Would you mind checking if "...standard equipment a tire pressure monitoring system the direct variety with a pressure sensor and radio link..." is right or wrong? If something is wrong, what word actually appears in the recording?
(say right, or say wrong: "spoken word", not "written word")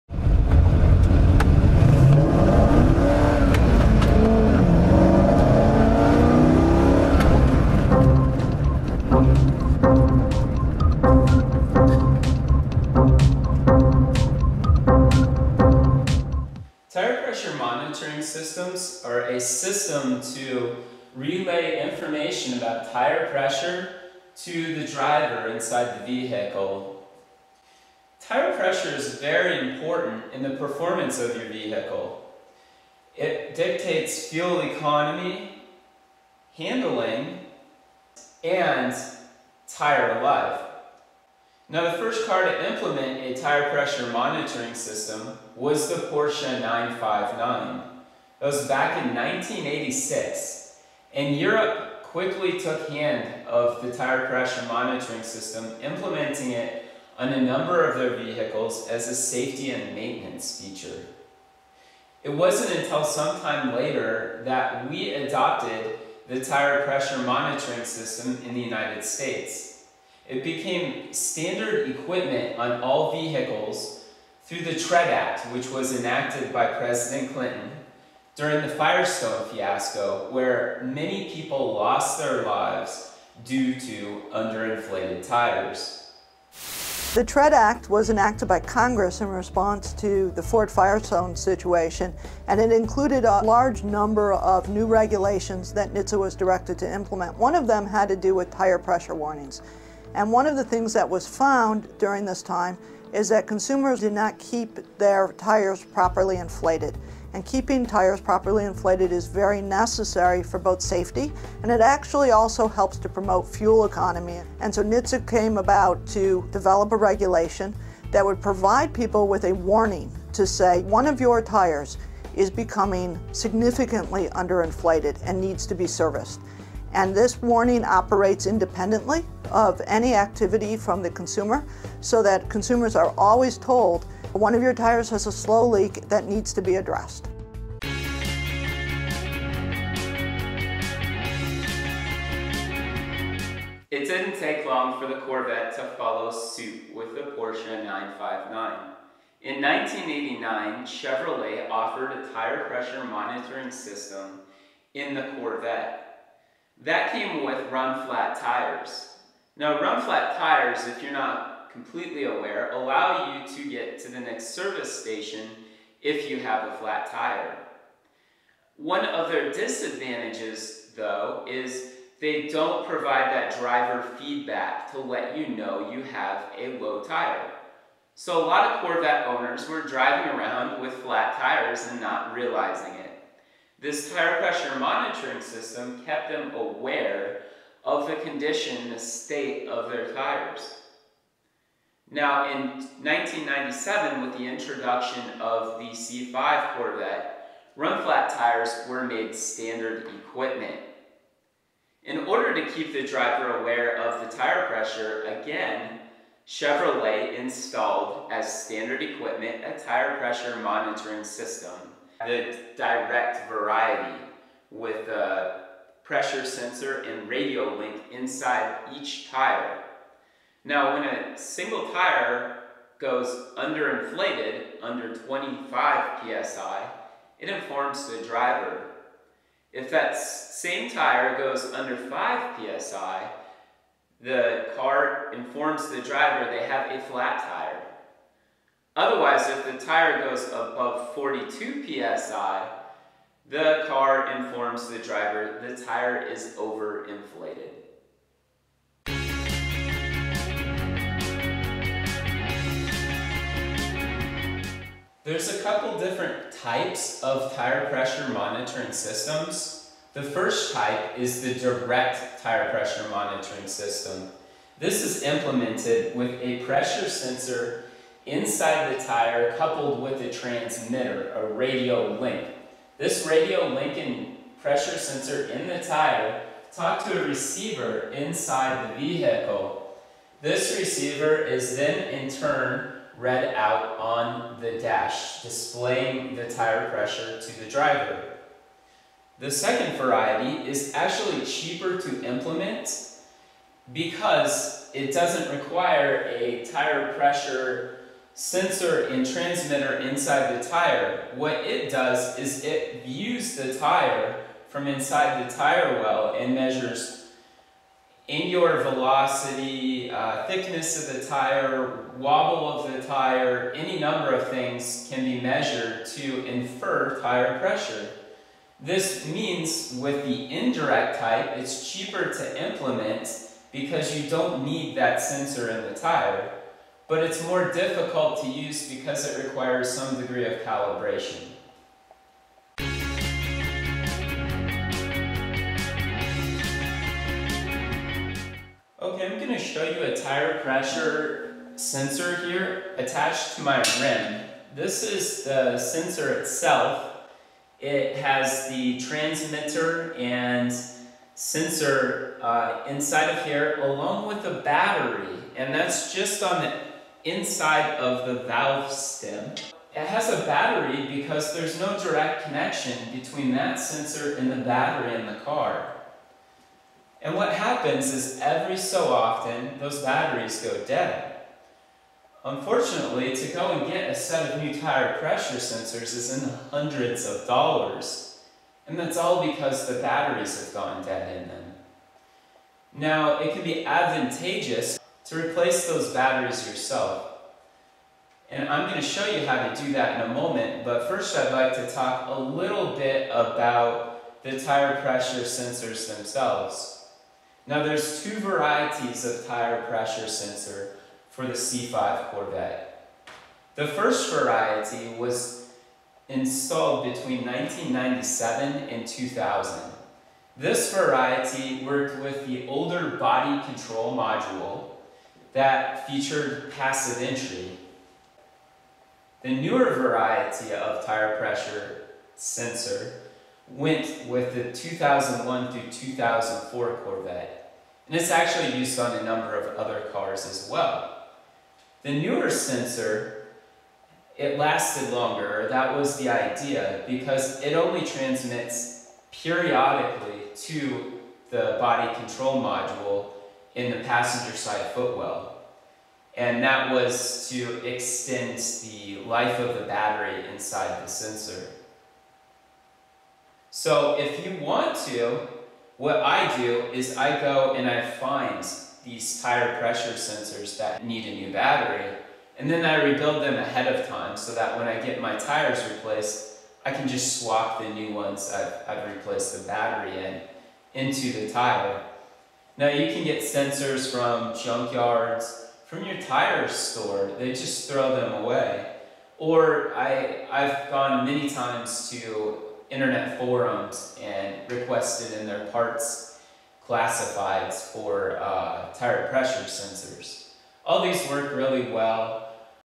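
right.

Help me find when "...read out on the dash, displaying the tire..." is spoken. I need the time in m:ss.
4:43.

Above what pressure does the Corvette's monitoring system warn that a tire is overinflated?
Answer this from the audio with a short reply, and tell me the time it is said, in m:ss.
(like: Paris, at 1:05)
42 psi, at 4:01.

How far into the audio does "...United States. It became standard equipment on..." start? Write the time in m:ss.
1:08.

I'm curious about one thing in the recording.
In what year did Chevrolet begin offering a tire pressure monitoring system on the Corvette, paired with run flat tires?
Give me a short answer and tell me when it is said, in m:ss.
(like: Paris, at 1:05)
1989, at 2:29.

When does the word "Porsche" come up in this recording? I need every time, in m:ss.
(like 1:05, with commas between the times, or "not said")
0:46, 2:27.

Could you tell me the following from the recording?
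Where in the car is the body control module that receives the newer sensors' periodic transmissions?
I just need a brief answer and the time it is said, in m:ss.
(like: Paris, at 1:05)
Passenger side footwell, at 7:24.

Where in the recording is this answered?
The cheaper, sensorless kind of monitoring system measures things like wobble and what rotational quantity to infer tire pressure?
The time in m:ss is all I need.
5:08.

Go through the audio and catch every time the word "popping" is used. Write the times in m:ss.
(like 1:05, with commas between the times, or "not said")
not said.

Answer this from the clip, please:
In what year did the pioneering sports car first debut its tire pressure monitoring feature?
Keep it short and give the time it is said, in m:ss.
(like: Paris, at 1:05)
1986, at 0:49.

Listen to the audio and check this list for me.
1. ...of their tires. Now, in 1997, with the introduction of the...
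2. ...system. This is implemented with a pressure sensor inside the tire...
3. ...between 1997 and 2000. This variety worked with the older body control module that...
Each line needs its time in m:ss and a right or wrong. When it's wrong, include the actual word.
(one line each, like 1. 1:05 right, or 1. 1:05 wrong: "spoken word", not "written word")
1. 3:09 right
2. 4:23 right
3. 6:47 right.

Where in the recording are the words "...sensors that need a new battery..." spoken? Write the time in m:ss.
7:40.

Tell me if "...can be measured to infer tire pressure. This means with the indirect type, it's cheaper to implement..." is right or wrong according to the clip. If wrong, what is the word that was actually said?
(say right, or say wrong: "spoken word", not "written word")
right.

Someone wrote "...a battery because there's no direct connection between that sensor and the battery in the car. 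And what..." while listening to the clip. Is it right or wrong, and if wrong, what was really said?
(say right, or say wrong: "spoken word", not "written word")
right.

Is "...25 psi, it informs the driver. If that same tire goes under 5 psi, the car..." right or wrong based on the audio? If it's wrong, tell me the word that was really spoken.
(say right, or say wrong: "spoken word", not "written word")
right.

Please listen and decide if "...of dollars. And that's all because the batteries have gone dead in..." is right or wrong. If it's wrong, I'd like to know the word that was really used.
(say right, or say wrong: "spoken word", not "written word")
right.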